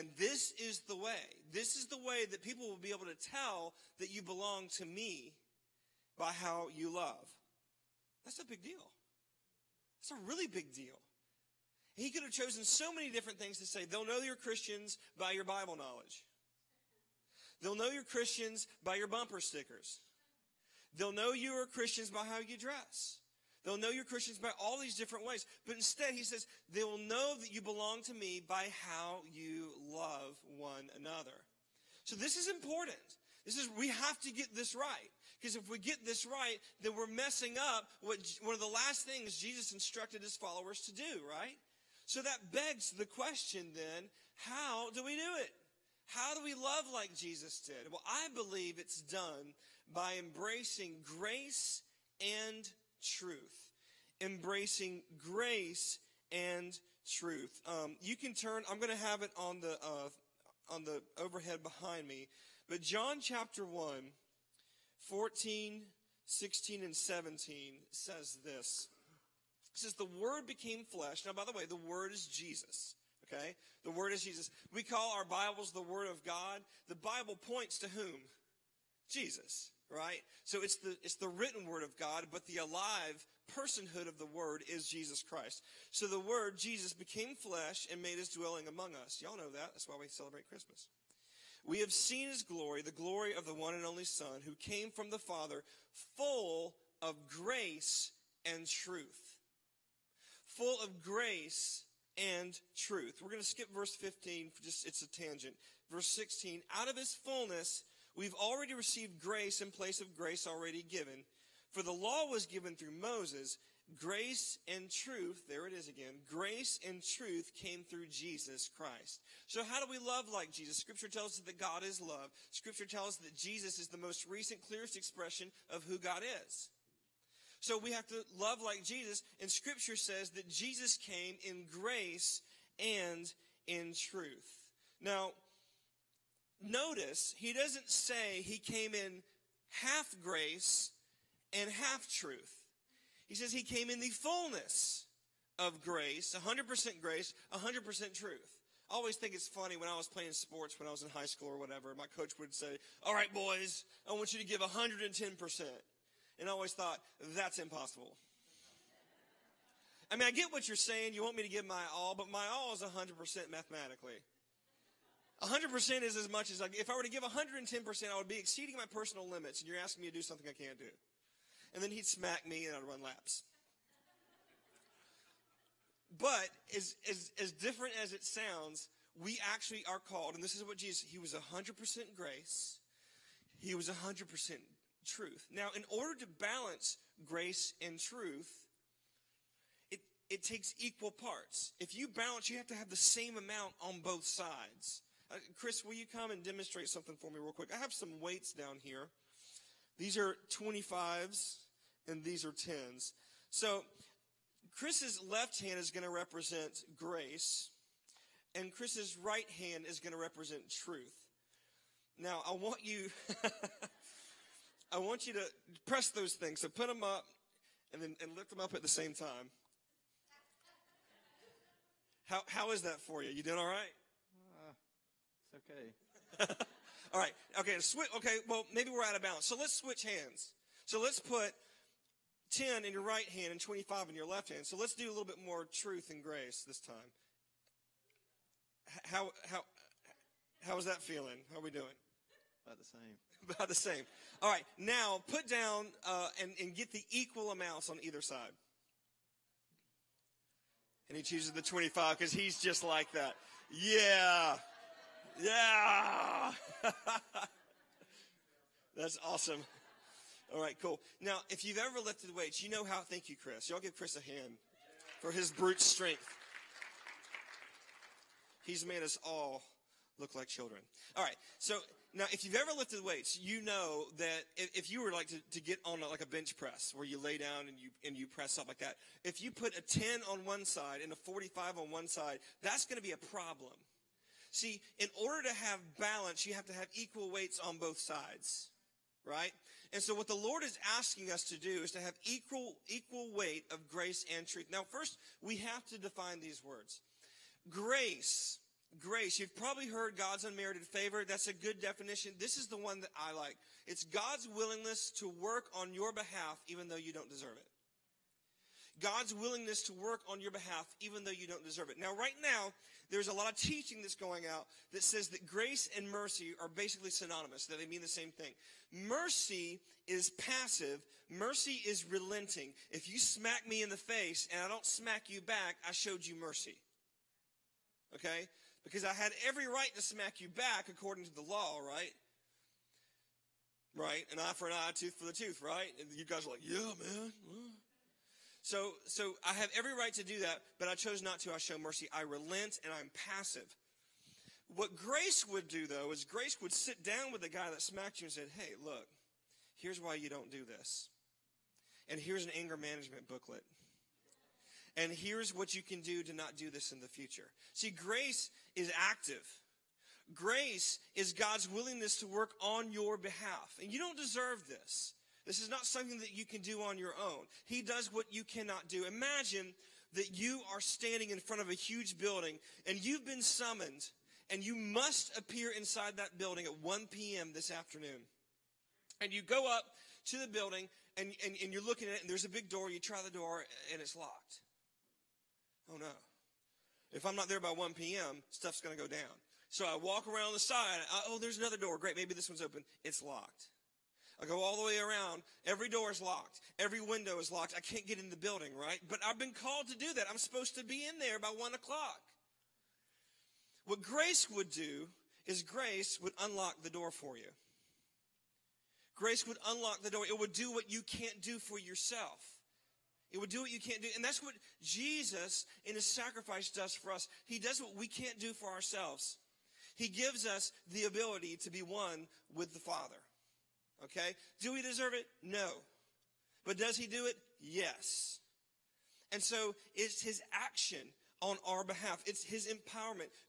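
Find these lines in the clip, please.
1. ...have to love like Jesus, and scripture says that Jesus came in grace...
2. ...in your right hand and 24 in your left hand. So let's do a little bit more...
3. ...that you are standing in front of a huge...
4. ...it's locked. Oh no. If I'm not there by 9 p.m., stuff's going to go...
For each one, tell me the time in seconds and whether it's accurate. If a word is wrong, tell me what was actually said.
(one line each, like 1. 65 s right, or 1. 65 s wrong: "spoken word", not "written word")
1. 127 s right
2. 232 s wrong: "25", not "24"
3. 370 s right
4. 384 s wrong: "1", not "9".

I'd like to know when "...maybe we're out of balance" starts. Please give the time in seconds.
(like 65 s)
228 s.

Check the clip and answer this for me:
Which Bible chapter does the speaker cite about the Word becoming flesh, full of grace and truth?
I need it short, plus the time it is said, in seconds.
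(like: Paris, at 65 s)
John chapter 1, at 62 s.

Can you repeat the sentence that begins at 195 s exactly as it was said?
Uh, Chris, will you come and demonstrate something for me real quick?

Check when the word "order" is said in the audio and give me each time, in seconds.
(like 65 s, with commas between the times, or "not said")
185 s, 285 s.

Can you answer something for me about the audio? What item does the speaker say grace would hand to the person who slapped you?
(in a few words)
An anger management booklet.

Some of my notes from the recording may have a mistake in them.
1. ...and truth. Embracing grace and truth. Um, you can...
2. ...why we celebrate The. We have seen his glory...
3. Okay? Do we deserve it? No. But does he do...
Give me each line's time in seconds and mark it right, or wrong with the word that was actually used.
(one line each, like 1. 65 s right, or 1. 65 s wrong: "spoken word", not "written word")
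1. 52 s right
2. 89 s wrong: "Christmas", not "The"
3. 424 s right.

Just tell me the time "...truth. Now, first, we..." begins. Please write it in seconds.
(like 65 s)
294 s.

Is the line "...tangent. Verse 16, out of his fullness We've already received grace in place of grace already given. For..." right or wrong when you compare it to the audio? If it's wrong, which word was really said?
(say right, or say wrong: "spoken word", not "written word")
right.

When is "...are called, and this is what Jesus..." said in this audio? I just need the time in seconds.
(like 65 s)
179 s.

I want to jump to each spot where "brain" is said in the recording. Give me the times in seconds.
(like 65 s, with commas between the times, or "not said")
not said.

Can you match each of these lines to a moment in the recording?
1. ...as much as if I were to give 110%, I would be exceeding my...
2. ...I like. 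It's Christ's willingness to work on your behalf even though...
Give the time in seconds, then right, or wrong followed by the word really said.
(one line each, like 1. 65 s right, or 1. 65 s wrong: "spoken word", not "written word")
1. 166 s right
2. 303 s wrong: "God", not "Christ".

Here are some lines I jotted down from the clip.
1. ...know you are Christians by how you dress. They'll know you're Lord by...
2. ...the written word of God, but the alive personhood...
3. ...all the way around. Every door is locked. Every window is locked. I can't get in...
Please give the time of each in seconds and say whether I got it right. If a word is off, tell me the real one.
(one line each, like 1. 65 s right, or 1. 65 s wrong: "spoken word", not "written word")
1. 21 s wrong: "Christians", not "Lord"
2. 81 s right
3. 394 s right.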